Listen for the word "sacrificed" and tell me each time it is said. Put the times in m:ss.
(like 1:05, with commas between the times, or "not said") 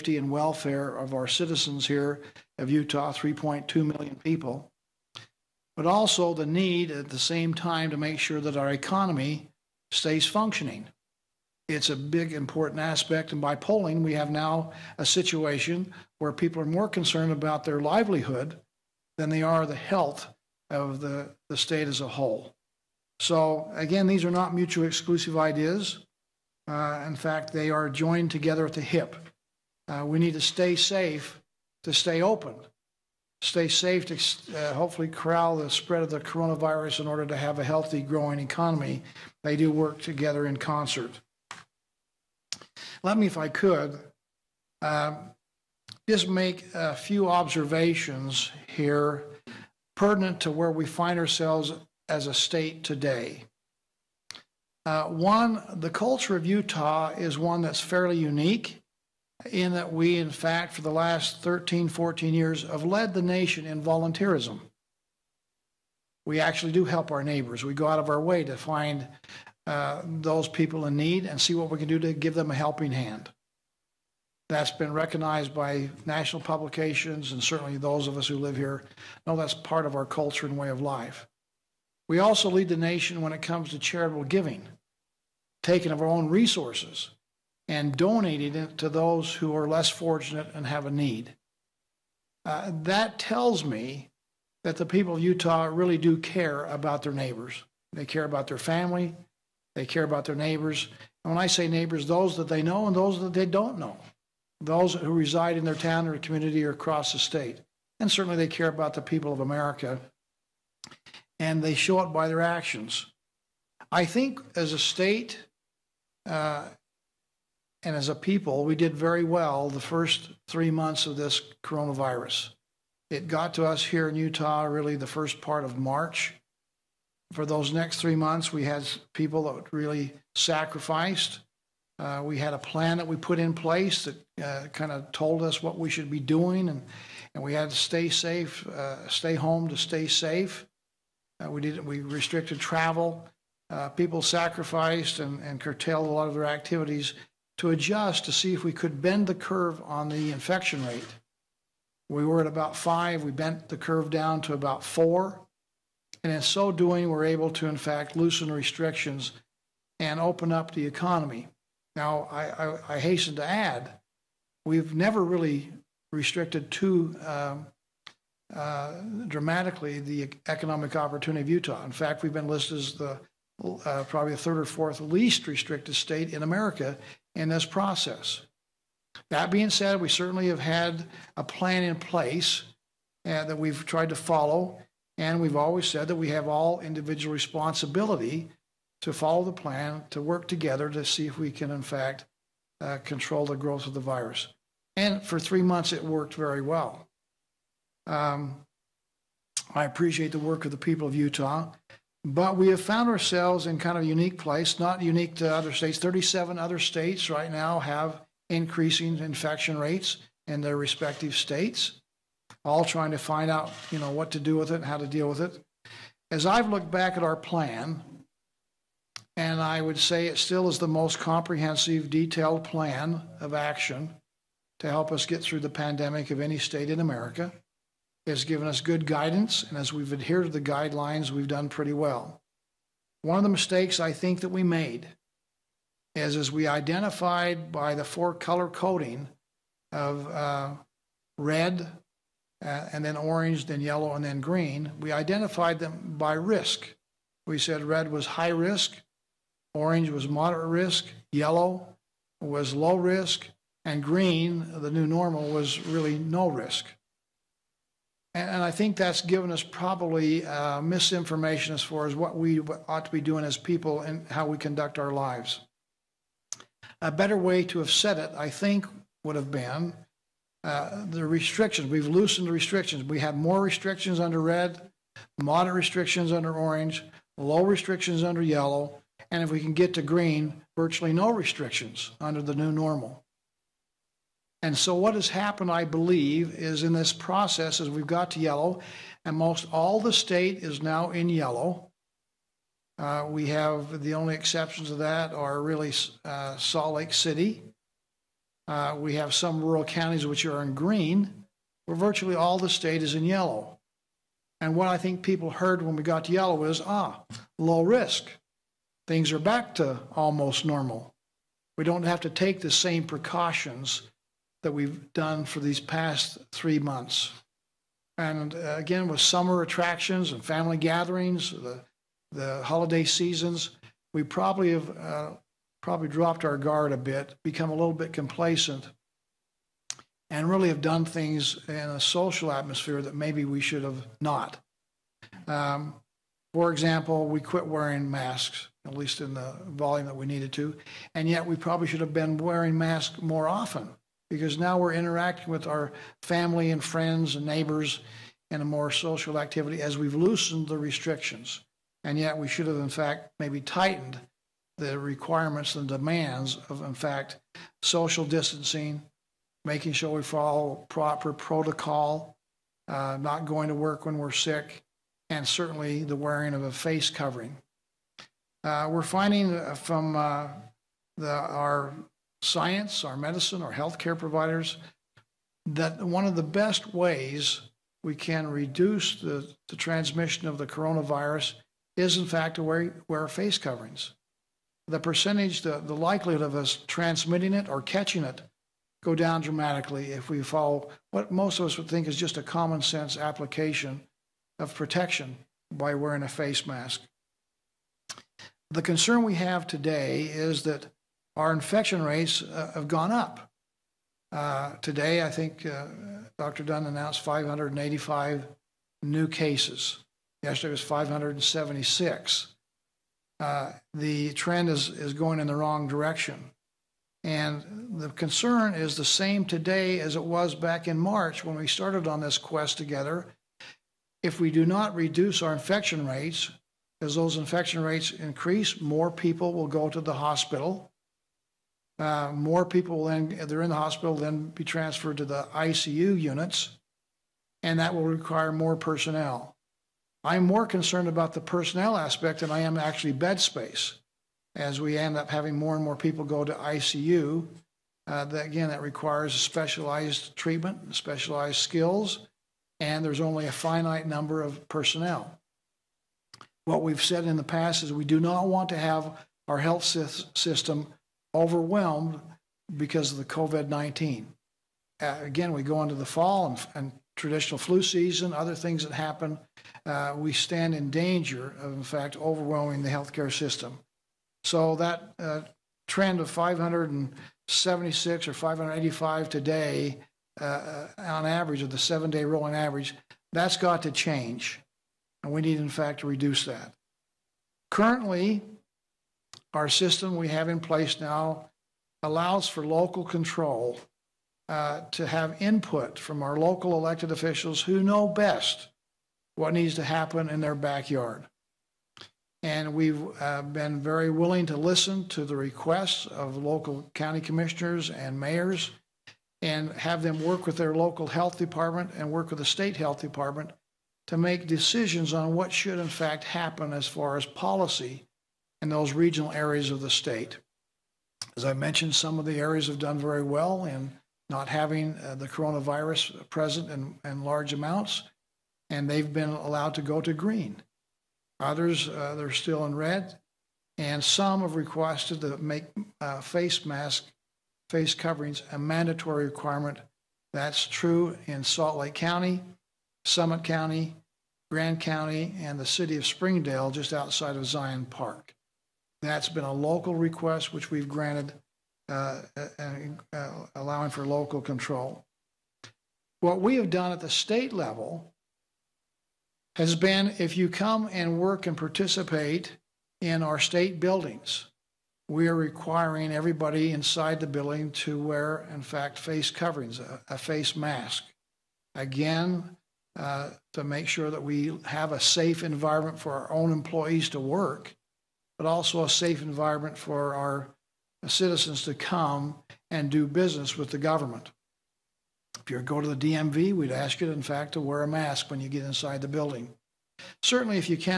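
2:10, 2:24.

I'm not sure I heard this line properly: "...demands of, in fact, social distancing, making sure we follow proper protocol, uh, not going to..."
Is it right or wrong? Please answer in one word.
right.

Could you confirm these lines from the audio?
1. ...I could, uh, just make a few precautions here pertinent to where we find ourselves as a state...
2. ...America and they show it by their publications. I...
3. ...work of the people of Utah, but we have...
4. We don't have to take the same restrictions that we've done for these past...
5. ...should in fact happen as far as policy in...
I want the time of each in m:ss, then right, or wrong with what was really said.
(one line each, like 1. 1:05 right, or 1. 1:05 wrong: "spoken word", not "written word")
1. 0:43 wrong: "observations", not "precautions"
2. 1:49 wrong: "actions", not "publications"
3. 3:20 right
4. 5:11 wrong: "precautions", not "restrictions"
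5. 8:35 right.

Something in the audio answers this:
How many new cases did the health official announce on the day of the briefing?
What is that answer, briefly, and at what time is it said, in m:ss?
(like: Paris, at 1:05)
585, at 6:47.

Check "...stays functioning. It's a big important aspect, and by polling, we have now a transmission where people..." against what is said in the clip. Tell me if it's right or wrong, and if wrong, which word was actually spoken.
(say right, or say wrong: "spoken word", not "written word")
wrong: "situation", not "transmission".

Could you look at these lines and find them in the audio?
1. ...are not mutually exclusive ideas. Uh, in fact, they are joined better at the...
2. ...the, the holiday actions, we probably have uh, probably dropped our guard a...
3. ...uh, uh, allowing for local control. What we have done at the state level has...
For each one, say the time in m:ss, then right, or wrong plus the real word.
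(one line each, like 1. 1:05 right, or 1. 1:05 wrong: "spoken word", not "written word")
1. 0:24 wrong: "together", not "better"
2. 5:21 wrong: "seasons", not "actions"
3. 9:12 right.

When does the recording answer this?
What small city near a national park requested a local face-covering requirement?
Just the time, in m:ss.
9:05.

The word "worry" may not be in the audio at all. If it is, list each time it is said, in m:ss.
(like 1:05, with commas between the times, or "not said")
not said.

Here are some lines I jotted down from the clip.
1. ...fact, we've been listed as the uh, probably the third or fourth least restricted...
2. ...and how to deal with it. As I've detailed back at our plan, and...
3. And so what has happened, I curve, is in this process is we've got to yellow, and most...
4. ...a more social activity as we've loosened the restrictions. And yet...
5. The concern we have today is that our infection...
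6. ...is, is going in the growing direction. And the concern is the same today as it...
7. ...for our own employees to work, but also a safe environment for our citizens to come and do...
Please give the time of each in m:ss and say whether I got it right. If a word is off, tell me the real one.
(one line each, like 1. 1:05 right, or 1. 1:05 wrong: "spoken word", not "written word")
1. 2:51 right
2. 3:34 wrong: "looked", not "detailed"
3. 4:44 wrong: "believe", not "curve"
4. 5:48 right
5. 6:38 right
6. 6:54 wrong: "wrong", not "growing"
7. 9:35 right.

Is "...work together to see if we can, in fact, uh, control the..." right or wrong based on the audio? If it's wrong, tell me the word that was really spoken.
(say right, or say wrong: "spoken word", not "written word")
right.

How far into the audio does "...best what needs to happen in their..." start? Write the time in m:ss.
8:18.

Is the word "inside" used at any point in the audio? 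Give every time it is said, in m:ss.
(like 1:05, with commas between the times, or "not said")
9:26, 9:48.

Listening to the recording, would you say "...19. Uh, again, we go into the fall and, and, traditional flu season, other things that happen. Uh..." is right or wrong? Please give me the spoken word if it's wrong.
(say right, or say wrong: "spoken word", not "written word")
right.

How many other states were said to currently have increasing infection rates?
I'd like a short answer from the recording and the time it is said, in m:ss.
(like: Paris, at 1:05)
37, at 3:25.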